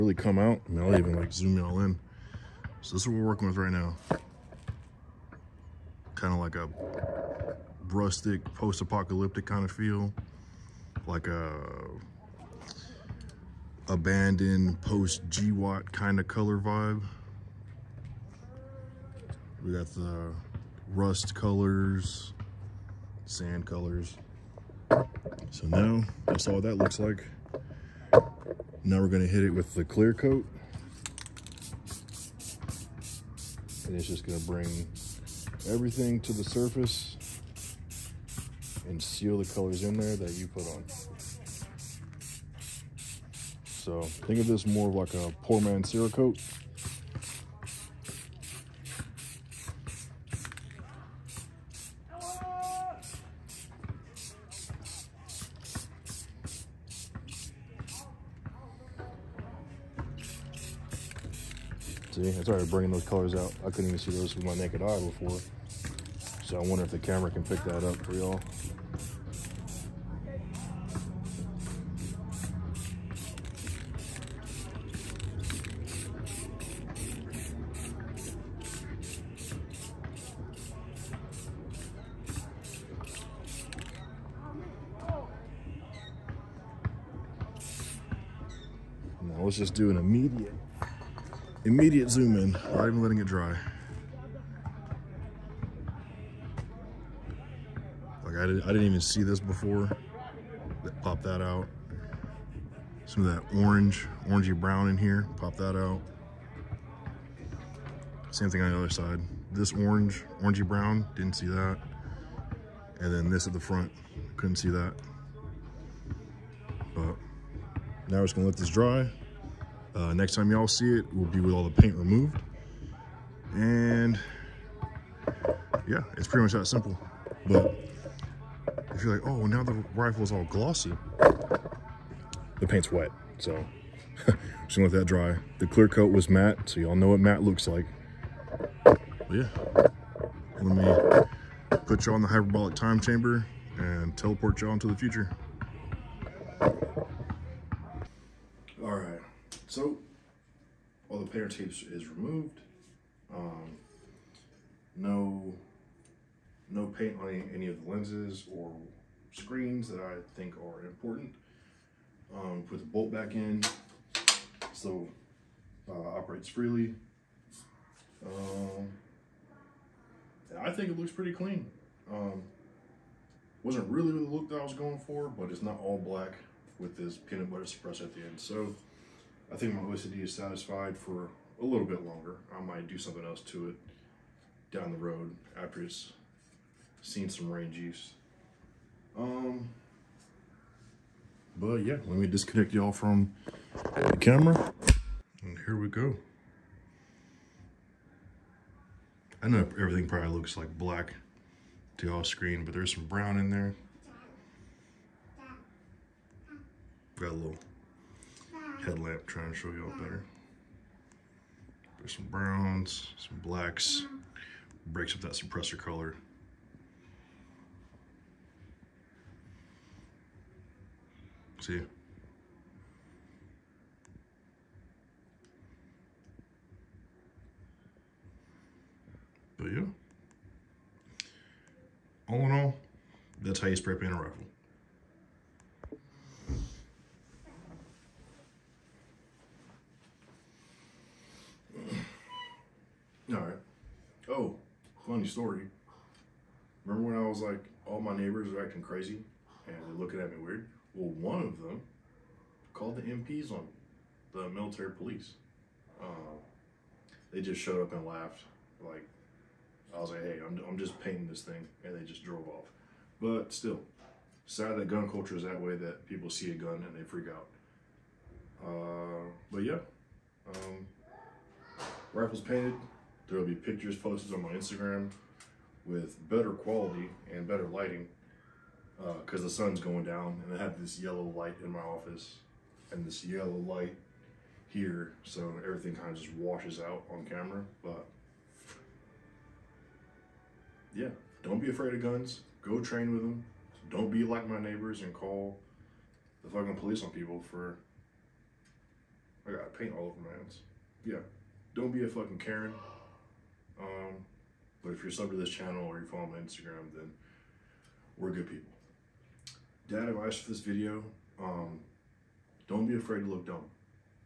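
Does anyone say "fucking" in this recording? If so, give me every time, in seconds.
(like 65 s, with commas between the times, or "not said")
296 s, 302 s.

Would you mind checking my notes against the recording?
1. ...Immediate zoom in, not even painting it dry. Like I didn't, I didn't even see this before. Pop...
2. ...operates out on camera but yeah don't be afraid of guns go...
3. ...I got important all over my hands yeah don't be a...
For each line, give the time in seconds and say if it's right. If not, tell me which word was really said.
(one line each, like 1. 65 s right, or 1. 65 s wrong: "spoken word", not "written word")
1. 91 s wrong: "letting", not "painting"
2. 286 s wrong: "washes", not "operates"
3. 299 s wrong: "paint", not "important".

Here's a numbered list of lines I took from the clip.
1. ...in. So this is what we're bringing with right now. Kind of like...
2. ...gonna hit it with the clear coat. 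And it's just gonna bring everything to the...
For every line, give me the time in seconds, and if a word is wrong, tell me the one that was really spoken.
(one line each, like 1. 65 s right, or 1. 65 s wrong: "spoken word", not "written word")
1. 1 s wrong: "working", not "bringing"
2. 29 s right.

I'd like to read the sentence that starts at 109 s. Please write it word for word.
This orange, orangey brown, didn't see that.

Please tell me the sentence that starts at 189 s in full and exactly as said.
Um, but yeah, let me disconnect y'all from the camera.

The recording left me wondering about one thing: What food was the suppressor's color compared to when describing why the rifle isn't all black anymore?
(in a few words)
Peanut butter.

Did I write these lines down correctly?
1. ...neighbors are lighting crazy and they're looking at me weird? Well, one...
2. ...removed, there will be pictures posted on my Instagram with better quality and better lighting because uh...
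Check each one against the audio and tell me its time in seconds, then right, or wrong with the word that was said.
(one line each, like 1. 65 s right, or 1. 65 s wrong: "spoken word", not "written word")
1. 248 s wrong: "acting", not "lighting"
2. 272 s wrong: "painted", not "removed".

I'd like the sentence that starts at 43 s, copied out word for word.
So think of this more of like a poor man's coat.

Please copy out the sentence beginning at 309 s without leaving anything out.
Dad advice for this video, um, don't be afraid to look dumb.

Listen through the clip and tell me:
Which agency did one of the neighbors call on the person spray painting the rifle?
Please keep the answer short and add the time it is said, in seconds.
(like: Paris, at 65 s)
Military police, at 254 s.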